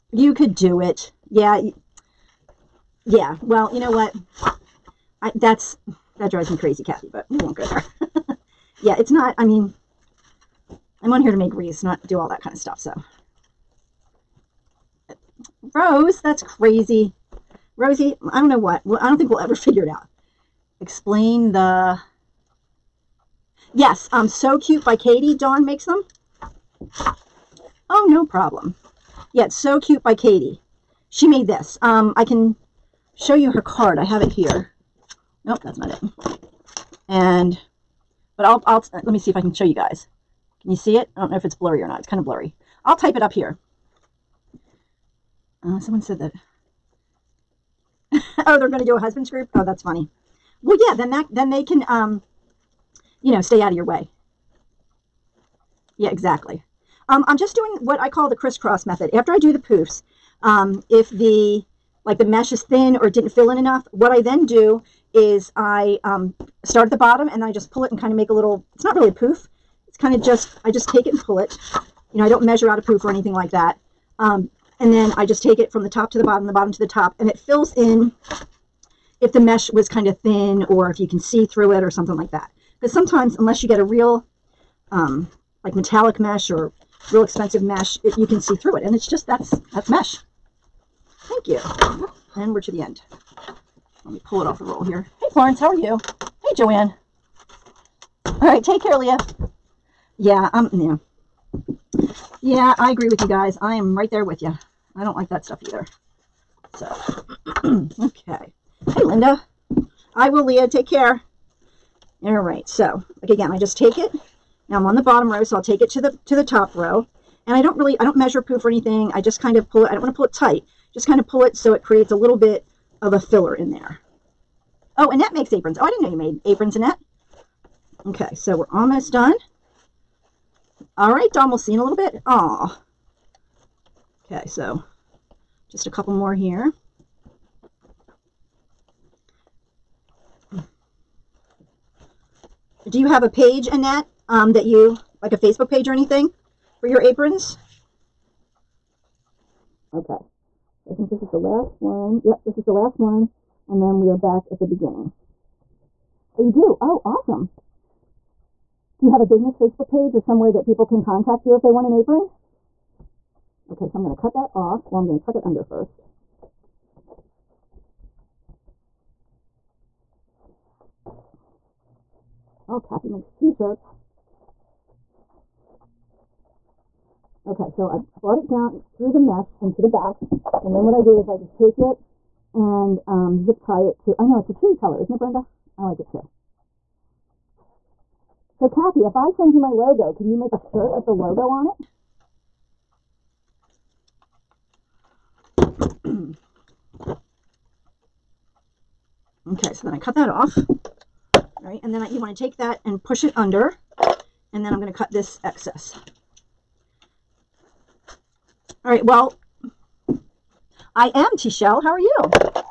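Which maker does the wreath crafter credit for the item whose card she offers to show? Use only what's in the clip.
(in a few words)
So Cute by Katie Dawn.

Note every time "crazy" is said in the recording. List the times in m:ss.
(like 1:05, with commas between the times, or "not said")
0:06, 0:16.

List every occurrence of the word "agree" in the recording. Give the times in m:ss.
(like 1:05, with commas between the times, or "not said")
1:42.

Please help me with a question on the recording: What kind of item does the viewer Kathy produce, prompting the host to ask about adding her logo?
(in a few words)
t-shirts.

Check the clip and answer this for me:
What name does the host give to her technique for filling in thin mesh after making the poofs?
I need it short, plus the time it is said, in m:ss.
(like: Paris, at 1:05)
crisscross method, at 0:58.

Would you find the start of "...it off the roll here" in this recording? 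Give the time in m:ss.
1:34.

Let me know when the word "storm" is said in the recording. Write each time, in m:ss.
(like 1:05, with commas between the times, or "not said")
not said.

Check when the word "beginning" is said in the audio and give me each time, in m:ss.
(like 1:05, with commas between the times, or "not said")
2:34.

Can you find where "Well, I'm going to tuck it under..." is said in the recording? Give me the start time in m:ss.
2:44.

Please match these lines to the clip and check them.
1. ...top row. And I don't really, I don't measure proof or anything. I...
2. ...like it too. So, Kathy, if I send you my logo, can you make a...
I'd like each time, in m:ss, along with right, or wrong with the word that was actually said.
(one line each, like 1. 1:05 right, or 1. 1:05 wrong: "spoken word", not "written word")
1. 1:56 right
2. 3:05 right.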